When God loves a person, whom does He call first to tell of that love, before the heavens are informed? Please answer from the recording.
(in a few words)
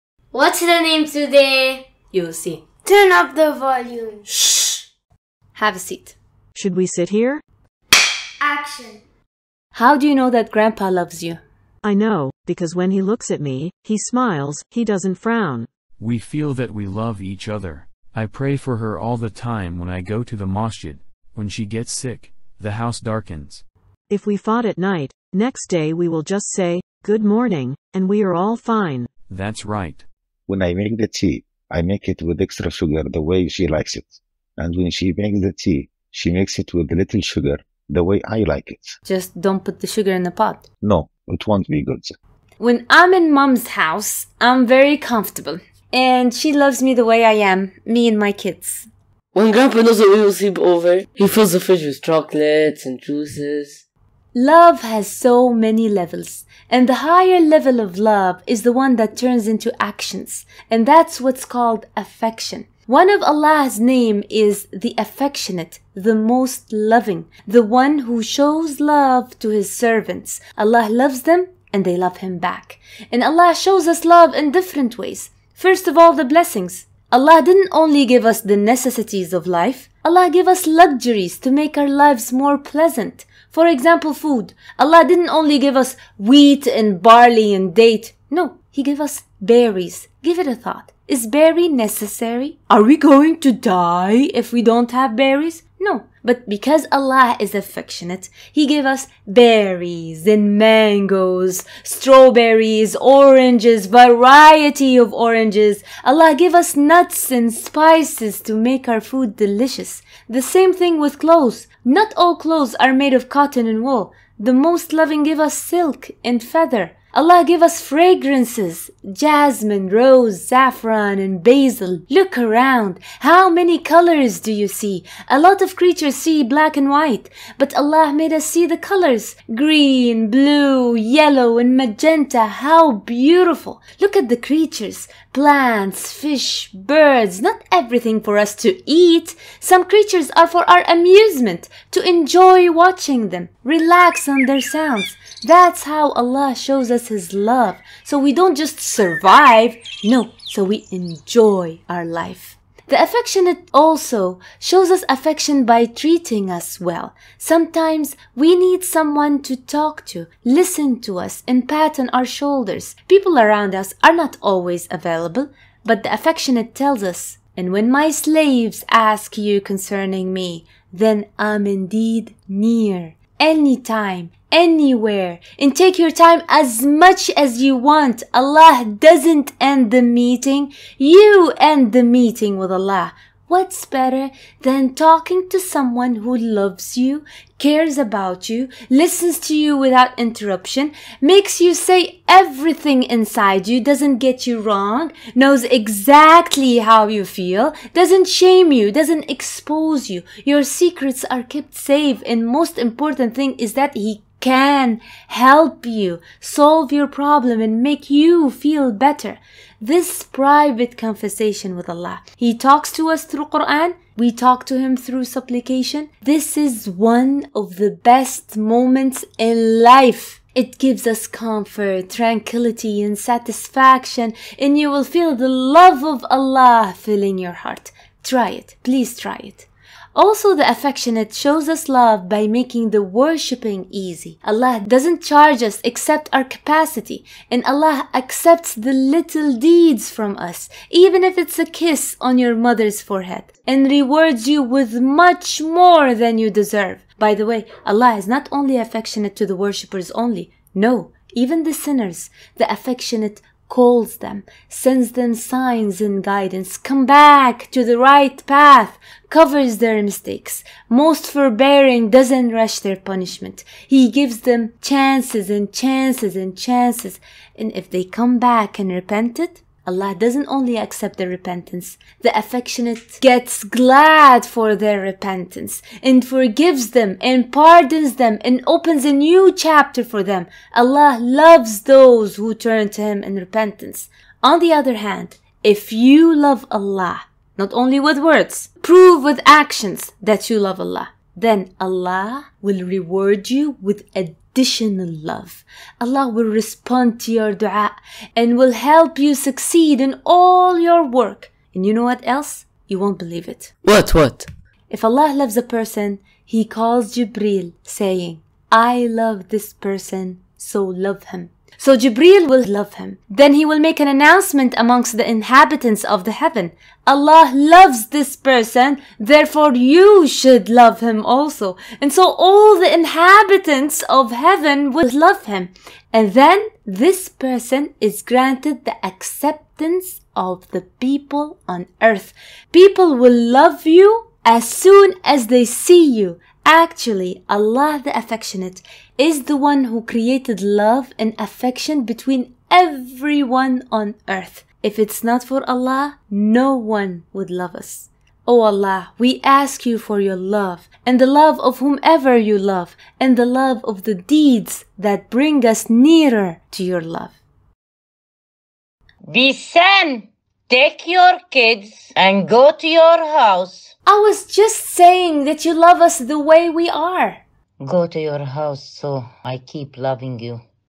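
Jibril.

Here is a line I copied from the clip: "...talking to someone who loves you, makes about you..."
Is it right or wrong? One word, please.
wrong.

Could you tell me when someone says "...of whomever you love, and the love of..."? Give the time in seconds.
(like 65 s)
351 s.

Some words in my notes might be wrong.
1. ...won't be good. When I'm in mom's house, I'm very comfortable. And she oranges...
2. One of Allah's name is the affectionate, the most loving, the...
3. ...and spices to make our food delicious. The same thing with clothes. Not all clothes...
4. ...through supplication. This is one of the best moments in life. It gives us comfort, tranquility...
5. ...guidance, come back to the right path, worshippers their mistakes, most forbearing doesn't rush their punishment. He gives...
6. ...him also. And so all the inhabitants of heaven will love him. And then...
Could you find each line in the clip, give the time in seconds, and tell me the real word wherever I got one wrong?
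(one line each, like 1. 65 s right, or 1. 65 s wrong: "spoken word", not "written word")
1. 41 s wrong: "loves", not "oranges"
2. 62 s right
3. 107 s right
4. 214 s right
5. 256 s wrong: "covers", not "worshippers"
6. 320 s right.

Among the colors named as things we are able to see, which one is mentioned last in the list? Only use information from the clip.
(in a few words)
Magenta.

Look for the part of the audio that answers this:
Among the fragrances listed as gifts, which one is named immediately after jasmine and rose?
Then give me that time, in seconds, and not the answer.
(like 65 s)
120 s.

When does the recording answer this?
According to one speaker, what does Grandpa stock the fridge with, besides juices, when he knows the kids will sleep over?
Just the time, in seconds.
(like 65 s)
52 s.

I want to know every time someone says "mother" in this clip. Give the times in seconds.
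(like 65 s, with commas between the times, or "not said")
242 s.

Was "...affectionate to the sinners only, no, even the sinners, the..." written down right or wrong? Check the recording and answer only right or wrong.
wrong.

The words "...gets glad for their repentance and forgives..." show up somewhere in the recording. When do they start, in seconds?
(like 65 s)
273 s.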